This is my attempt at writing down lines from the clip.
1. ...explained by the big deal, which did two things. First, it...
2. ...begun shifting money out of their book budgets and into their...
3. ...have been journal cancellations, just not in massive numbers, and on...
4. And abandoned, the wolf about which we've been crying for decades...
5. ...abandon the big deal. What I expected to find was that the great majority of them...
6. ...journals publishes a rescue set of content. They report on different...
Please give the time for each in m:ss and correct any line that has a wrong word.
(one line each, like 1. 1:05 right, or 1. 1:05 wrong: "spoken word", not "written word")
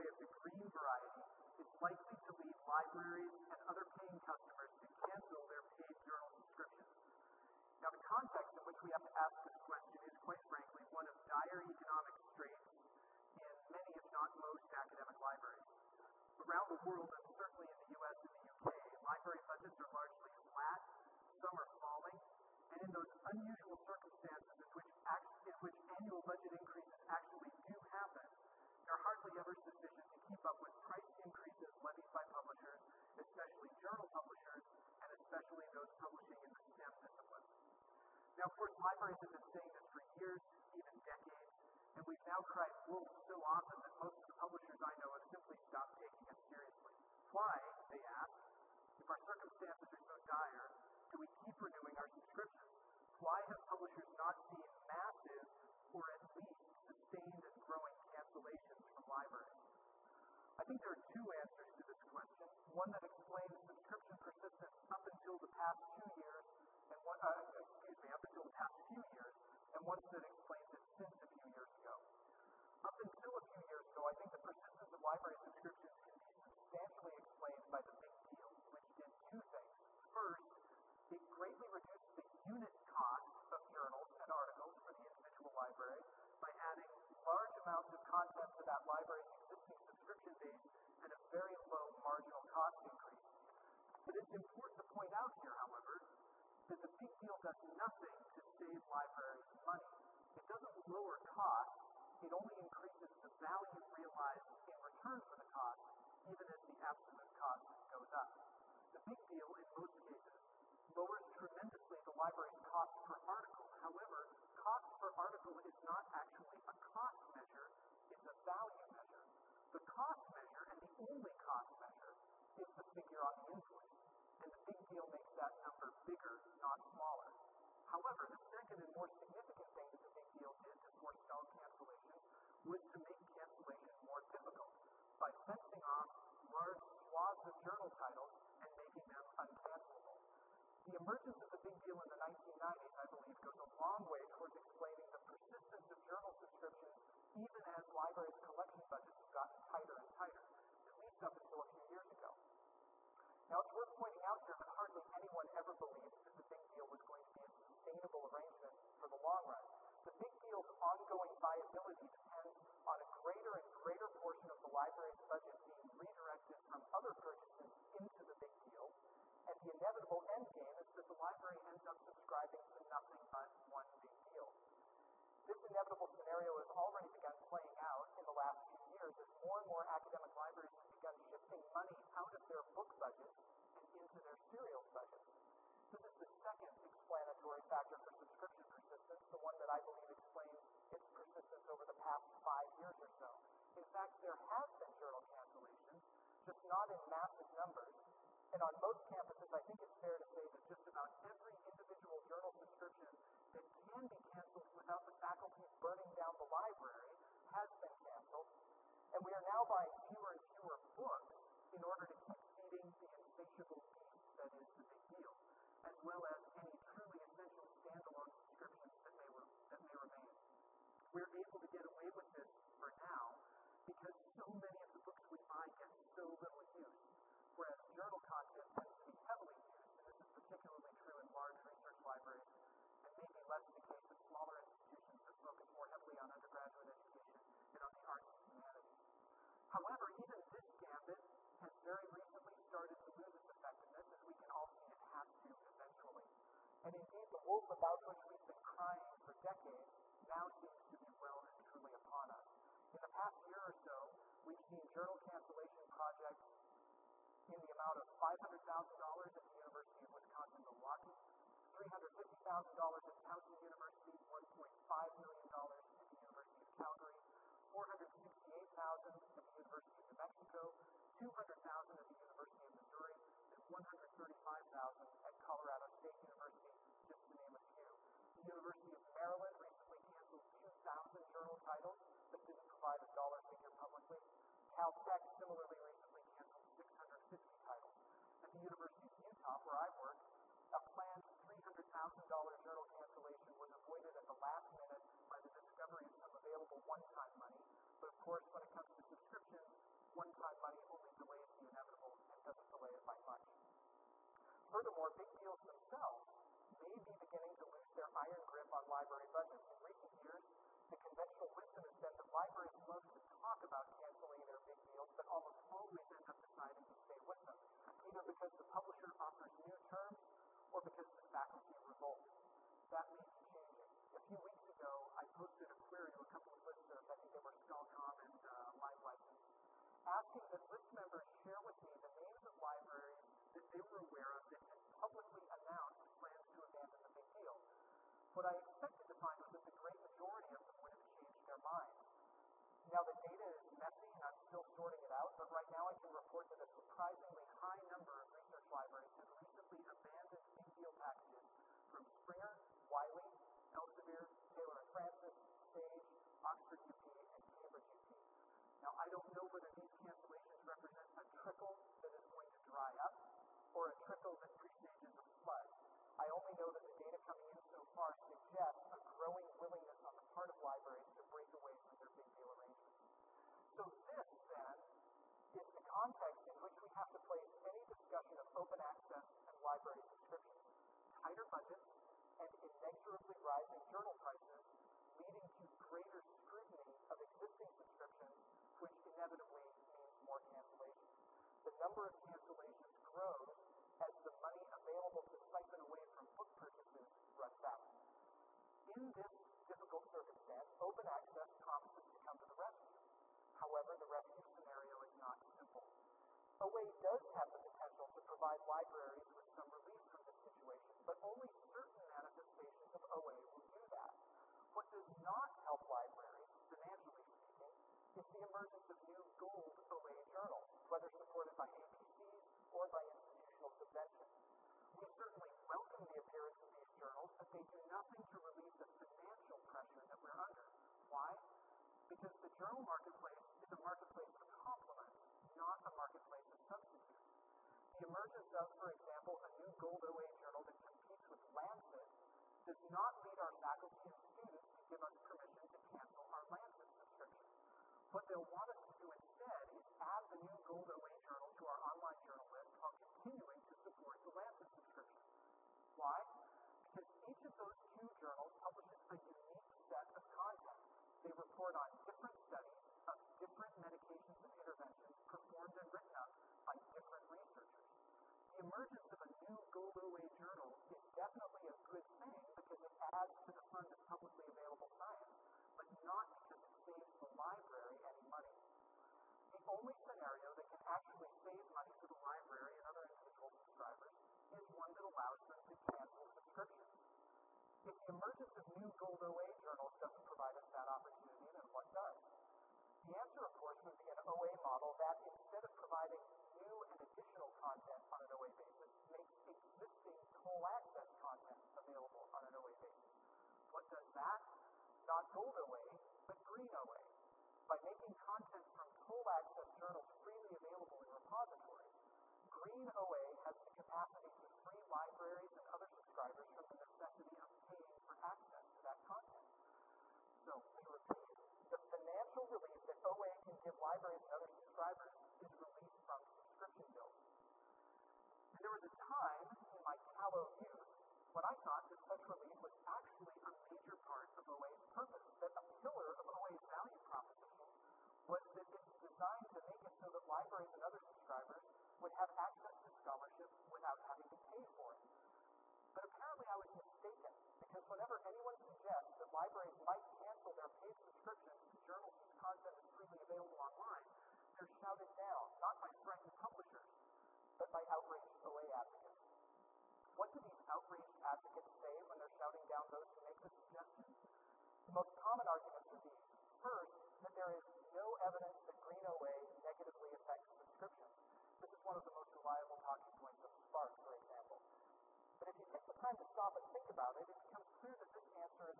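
1. 1:17 right
2. 3:00 right
3. 3:14 right
4. 4:06 wrong: "indeed", not "abandoned"
5. 5:36 right
6. 7:38 wrong: "unique", not "rescue".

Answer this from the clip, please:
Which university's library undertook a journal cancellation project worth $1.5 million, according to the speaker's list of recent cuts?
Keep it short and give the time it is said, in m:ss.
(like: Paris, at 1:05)
University of Calgary, at 4:26.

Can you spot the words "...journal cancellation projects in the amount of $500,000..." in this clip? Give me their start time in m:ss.
4:14.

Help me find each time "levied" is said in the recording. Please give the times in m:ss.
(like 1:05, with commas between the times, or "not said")
0:31.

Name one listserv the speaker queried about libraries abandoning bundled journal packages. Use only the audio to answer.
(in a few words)
SCHOLCOMM.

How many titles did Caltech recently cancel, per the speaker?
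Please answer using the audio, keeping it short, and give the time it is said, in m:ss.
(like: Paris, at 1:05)
650, at 4:46.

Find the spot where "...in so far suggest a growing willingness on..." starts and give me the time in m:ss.
6:07.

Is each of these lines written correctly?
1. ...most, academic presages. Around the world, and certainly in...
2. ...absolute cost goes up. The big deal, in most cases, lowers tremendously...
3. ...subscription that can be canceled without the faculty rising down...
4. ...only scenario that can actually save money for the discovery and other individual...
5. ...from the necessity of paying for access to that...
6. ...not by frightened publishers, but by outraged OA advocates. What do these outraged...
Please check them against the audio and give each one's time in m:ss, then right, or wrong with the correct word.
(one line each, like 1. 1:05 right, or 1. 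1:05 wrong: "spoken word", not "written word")
1. 0:14 wrong: "libraries", not "presages"
2. 1:46 right
3. 3:22 wrong: "burning", not "rising"
4. 7:59 wrong: "library", not "discovery"
5. 8:36 right
6. 9:15 right.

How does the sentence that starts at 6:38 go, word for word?
In this difficult circumstance, open access promises to come to the rescue.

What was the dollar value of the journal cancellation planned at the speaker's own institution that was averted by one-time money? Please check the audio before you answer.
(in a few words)
$300,000.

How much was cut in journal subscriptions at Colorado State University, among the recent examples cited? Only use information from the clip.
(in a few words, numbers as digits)
$135,000.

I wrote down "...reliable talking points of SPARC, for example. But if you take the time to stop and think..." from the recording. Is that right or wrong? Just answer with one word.
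right.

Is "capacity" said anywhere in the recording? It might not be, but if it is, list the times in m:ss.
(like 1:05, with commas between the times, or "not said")
8:33.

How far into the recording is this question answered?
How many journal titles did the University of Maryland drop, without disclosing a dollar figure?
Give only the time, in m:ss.
4:40.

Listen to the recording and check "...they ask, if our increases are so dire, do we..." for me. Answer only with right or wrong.
wrong.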